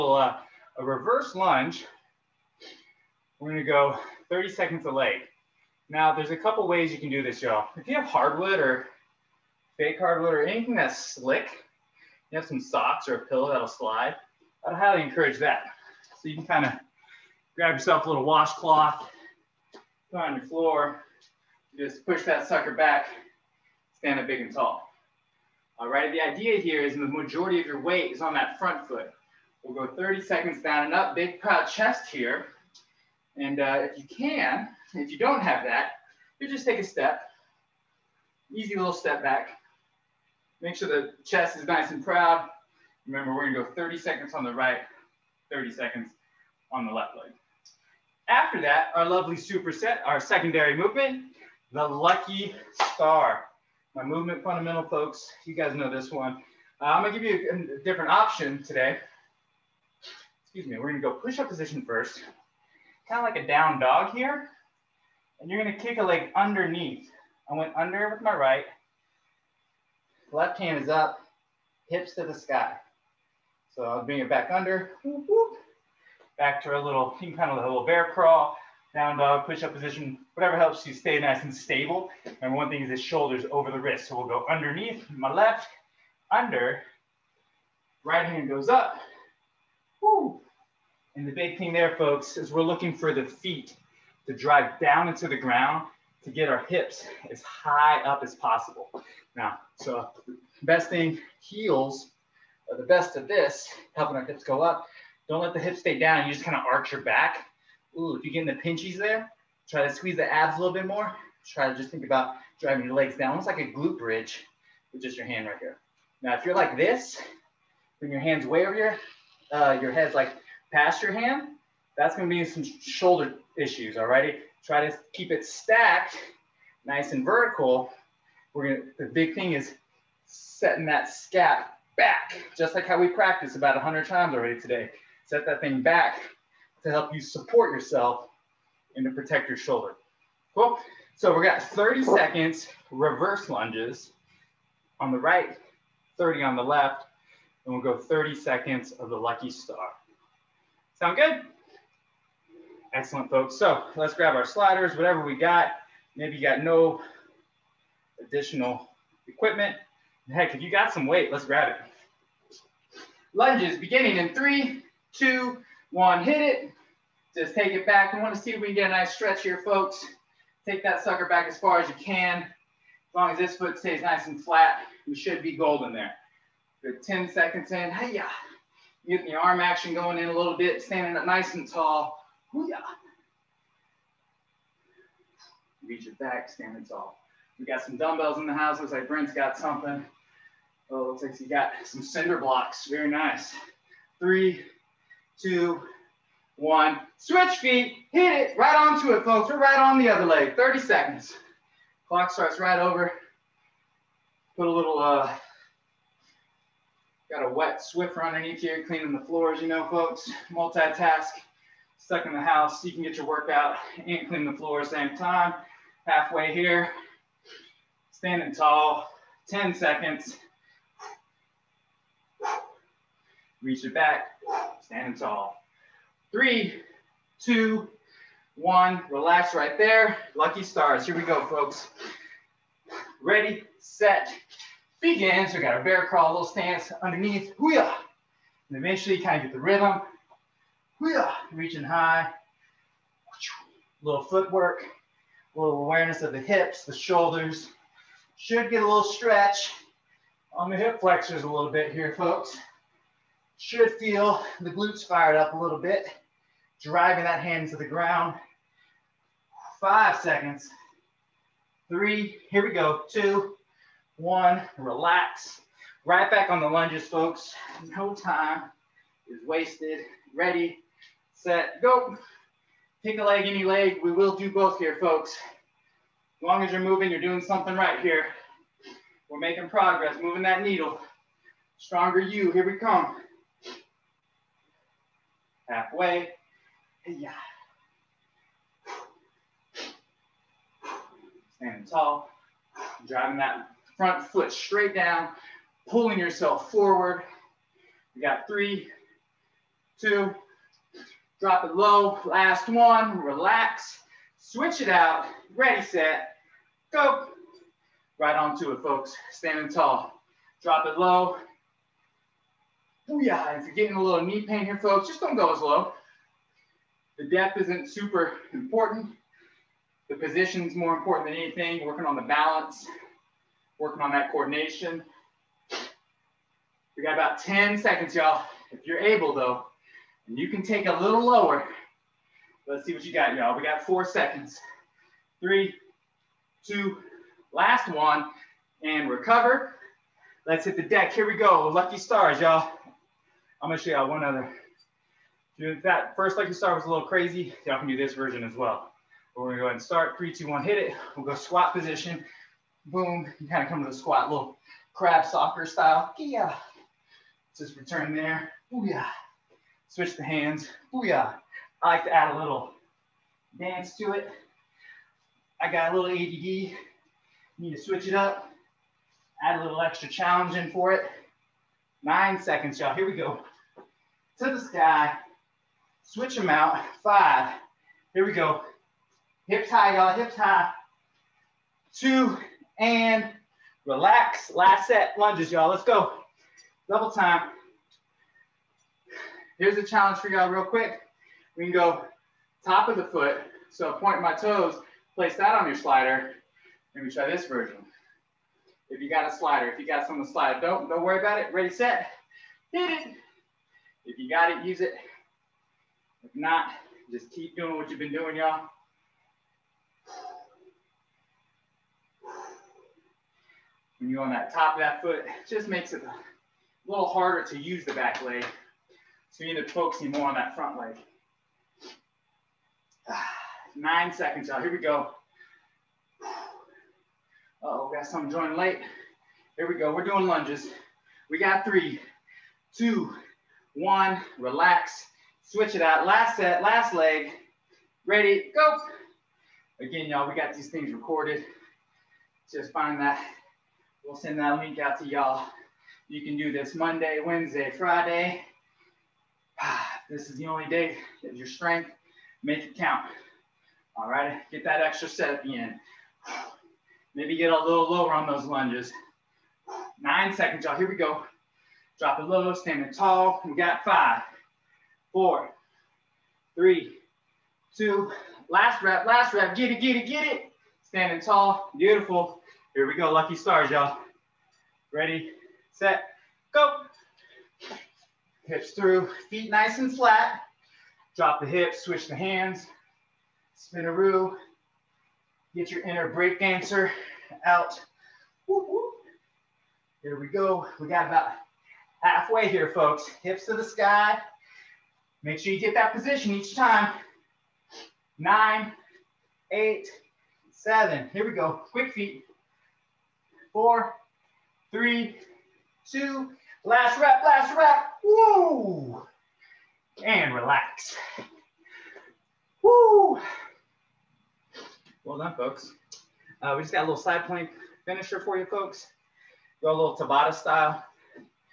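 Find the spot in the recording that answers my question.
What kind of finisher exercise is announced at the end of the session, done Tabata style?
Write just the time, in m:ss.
8:36.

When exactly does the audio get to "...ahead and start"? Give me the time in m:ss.
5:49.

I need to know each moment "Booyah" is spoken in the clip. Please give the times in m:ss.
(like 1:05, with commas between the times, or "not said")
5:13, 6:00.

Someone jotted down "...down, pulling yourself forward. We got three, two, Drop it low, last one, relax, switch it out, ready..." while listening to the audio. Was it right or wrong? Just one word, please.
right.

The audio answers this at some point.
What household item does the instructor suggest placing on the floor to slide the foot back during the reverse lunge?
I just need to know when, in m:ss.
0:18.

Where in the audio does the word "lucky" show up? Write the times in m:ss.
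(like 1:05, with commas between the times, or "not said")
0:51, 2:29, 3:50, 5:41, 5:46, 7:53.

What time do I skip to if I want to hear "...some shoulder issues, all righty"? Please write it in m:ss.
2:02.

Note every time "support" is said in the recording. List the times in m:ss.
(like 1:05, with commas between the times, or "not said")
2:17.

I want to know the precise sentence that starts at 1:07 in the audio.
I went under with my right.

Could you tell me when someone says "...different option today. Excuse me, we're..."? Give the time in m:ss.
0:57.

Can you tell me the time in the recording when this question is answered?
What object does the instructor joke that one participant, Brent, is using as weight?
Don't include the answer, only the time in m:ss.
3:12.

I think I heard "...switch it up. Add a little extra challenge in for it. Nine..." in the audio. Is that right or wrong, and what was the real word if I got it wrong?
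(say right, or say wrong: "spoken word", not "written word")
right.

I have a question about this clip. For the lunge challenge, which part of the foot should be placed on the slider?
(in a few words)
top of the foot.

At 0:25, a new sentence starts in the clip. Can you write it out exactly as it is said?
All right, the idea here is the majority of your weight is on that front foot.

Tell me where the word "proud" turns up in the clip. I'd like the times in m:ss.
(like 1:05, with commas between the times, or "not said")
0:31, 0:42.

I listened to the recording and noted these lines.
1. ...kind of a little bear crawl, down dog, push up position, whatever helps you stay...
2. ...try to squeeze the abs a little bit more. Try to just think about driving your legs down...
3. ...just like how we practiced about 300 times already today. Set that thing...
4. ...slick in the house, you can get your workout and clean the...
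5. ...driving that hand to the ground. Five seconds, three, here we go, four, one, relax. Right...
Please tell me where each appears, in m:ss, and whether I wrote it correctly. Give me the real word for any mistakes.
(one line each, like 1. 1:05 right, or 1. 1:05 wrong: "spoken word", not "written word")
1. 1:17 right
2. 1:49 right
3. 2:12 wrong: "100", not "300"
4. 3:32 wrong: "stuck", not "slick"
5. 4:16 wrong: "two", not "four".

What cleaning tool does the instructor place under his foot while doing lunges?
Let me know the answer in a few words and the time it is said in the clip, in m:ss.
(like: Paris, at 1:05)
wet Swiffer, at 3:27.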